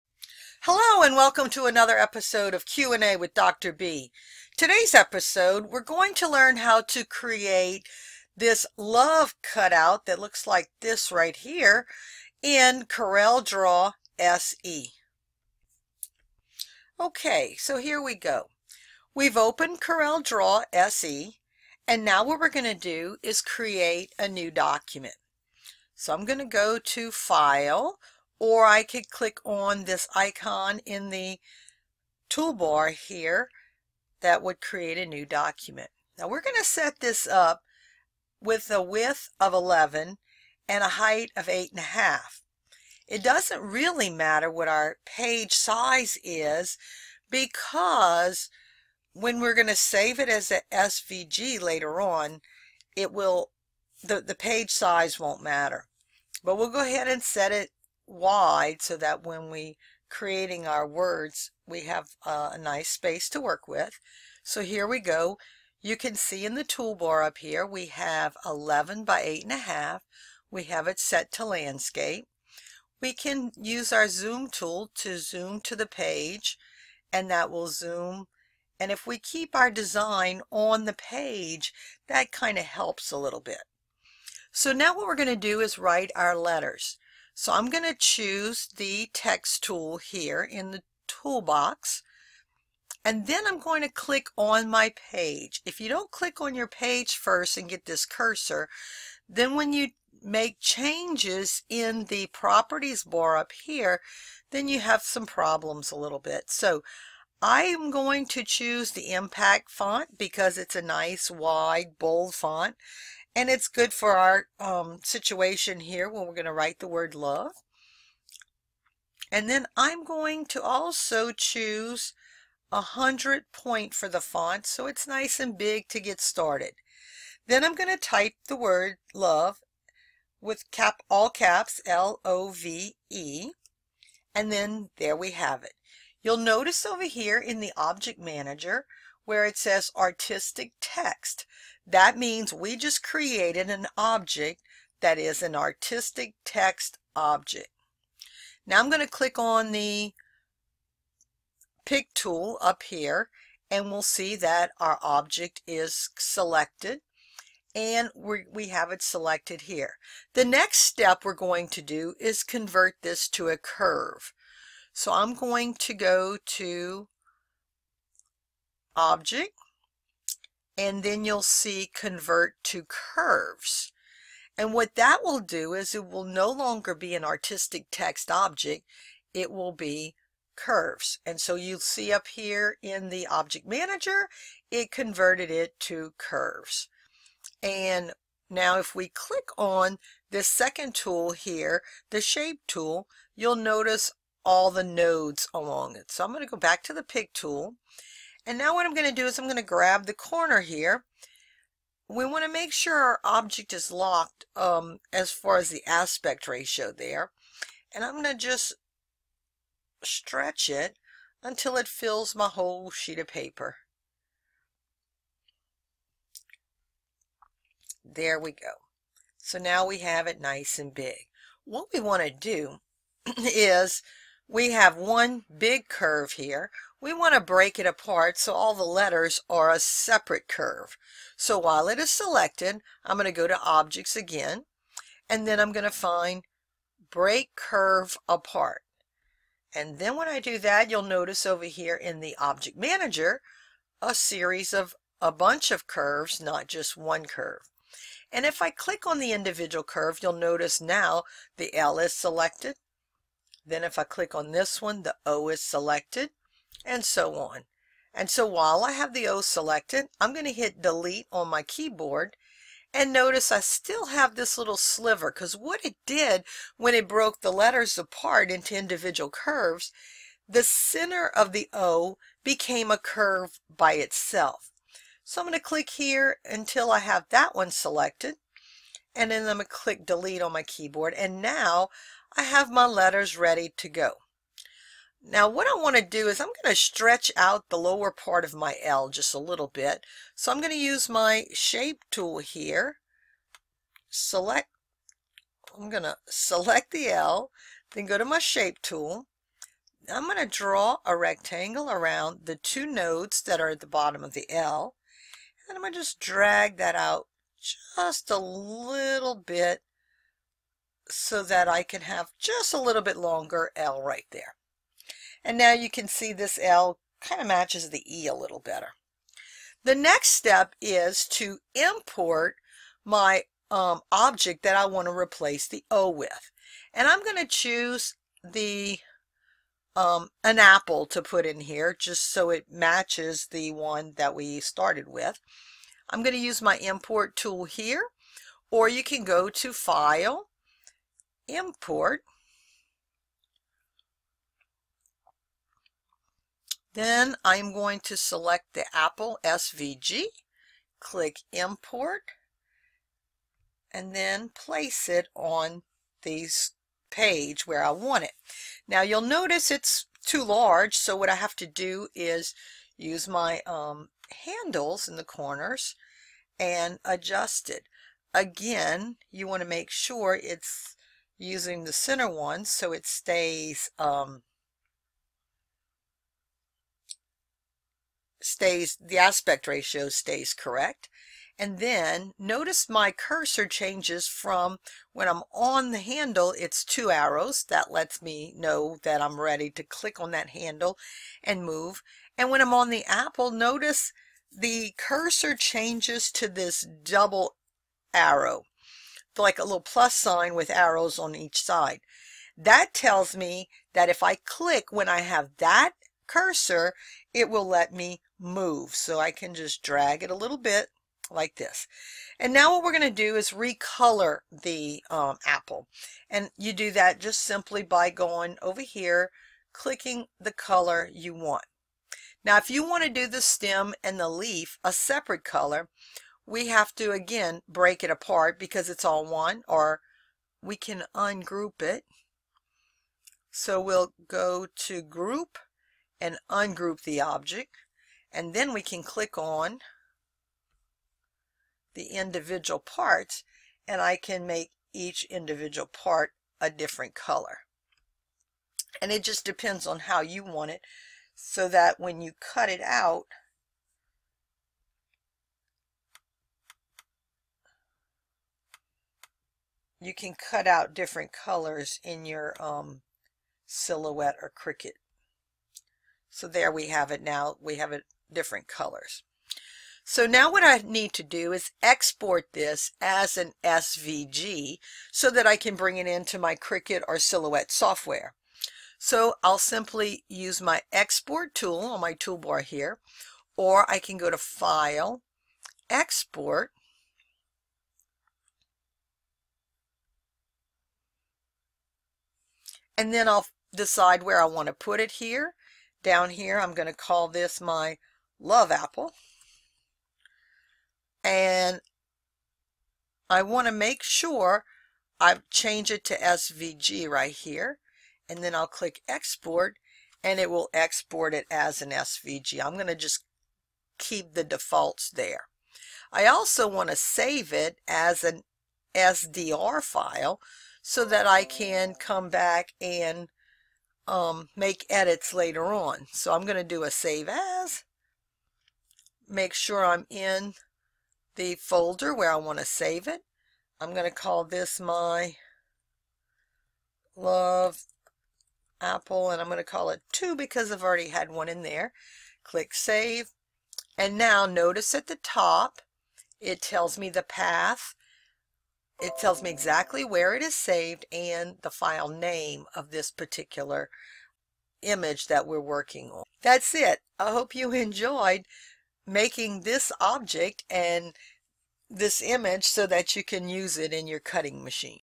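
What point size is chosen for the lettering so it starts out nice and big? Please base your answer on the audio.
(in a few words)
100.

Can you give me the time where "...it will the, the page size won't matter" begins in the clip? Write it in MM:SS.
00:52.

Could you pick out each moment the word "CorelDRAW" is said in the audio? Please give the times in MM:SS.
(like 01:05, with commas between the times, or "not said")
00:12, 00:19.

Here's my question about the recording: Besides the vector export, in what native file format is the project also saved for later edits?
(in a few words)
CDR.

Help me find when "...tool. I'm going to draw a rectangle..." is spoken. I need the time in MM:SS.
04:58.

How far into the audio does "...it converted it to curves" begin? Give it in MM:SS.
03:04.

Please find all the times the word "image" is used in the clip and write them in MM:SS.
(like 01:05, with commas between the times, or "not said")
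09:14, 09:22.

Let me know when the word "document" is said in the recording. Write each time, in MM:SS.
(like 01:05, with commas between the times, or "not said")
00:24, 00:35.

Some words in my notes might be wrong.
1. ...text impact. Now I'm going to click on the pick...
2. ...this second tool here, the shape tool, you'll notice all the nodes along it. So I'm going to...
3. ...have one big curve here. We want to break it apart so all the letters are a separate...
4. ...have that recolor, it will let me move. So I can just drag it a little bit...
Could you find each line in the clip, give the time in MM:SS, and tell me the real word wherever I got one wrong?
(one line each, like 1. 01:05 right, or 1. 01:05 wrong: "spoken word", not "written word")
1. 02:26 wrong: "object", not "impact"
2. 03:10 right
3. 03:44 right
4. 06:45 wrong: "cursor", not "recolor".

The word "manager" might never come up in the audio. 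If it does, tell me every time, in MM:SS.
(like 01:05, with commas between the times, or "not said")
02:18, 03:03, 04:02.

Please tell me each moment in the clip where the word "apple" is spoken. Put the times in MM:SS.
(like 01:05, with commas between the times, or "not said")
05:30, 05:48, 06:33, 06:55, 08:18, 08:58.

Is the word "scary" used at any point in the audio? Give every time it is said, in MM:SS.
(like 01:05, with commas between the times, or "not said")
not said.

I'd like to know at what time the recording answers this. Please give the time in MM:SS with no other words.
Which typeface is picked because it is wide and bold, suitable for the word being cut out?
01:49.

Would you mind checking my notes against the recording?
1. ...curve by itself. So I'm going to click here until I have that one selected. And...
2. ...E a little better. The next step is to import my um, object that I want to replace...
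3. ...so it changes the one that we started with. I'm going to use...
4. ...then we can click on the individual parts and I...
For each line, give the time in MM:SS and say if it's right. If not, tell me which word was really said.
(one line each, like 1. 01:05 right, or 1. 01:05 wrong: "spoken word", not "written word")
1. 04:32 right
2. 05:18 right
3. 05:32 wrong: "matches", not "changes"
4. 07:18 right.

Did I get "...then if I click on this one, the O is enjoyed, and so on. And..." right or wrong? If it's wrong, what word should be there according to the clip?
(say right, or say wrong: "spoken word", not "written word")
wrong: "selected", not "enjoyed".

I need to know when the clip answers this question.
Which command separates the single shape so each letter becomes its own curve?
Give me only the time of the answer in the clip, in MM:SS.
03:57.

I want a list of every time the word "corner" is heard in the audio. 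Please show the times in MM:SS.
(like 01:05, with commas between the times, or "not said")
03:20, 06:05.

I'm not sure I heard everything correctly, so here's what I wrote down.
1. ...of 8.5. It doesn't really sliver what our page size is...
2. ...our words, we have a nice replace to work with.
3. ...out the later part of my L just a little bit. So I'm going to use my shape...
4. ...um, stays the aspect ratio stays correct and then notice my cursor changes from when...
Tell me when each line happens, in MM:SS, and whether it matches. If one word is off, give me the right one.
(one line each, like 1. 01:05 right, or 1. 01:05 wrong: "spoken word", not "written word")
1. 00:41 wrong: "matter", not "sliver"
2. 01:00 wrong: "space", not "replace"
3. 04:47 wrong: "lower", not "later"
4. 06:13 right.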